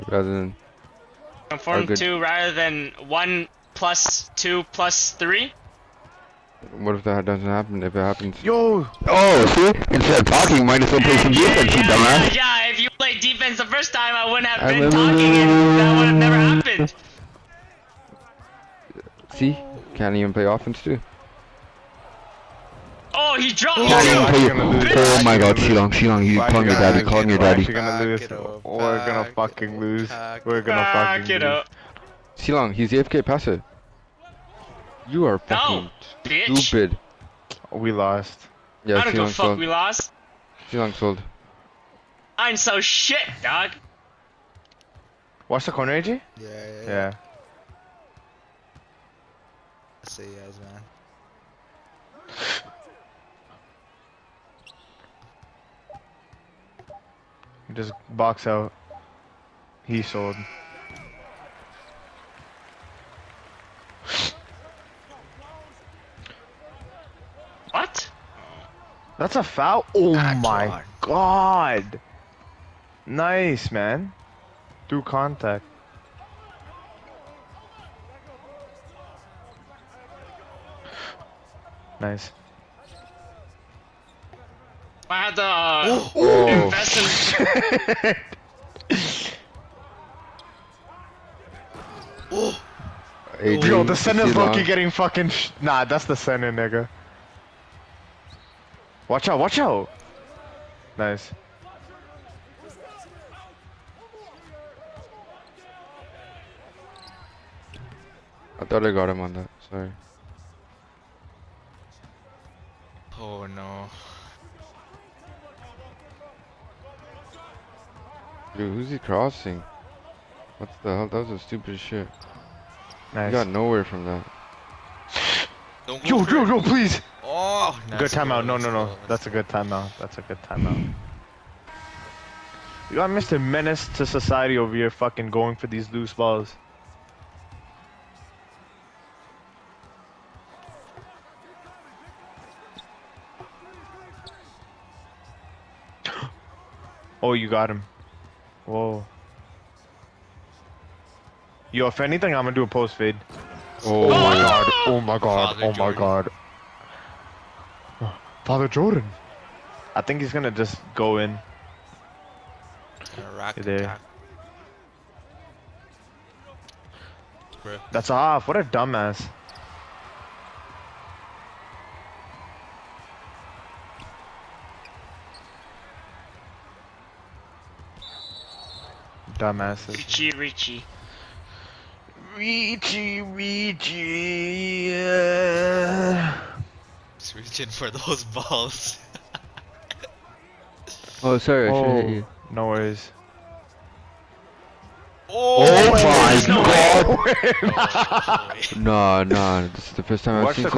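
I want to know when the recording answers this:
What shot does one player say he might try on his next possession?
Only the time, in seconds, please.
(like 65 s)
152 s.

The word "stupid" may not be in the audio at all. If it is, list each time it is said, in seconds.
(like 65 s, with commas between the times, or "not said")
36 s, 121 s.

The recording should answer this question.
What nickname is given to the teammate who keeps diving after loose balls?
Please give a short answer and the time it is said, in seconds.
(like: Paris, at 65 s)
Mr. Menace to society, at 133 s.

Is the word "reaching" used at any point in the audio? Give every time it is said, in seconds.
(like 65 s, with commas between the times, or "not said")
187 s.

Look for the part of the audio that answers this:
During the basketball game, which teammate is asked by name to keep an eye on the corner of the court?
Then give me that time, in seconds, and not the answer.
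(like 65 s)
46 s.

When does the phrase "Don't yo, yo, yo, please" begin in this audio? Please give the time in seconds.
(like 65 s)
125 s.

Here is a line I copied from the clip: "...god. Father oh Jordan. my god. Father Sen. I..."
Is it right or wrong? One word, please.
wrong.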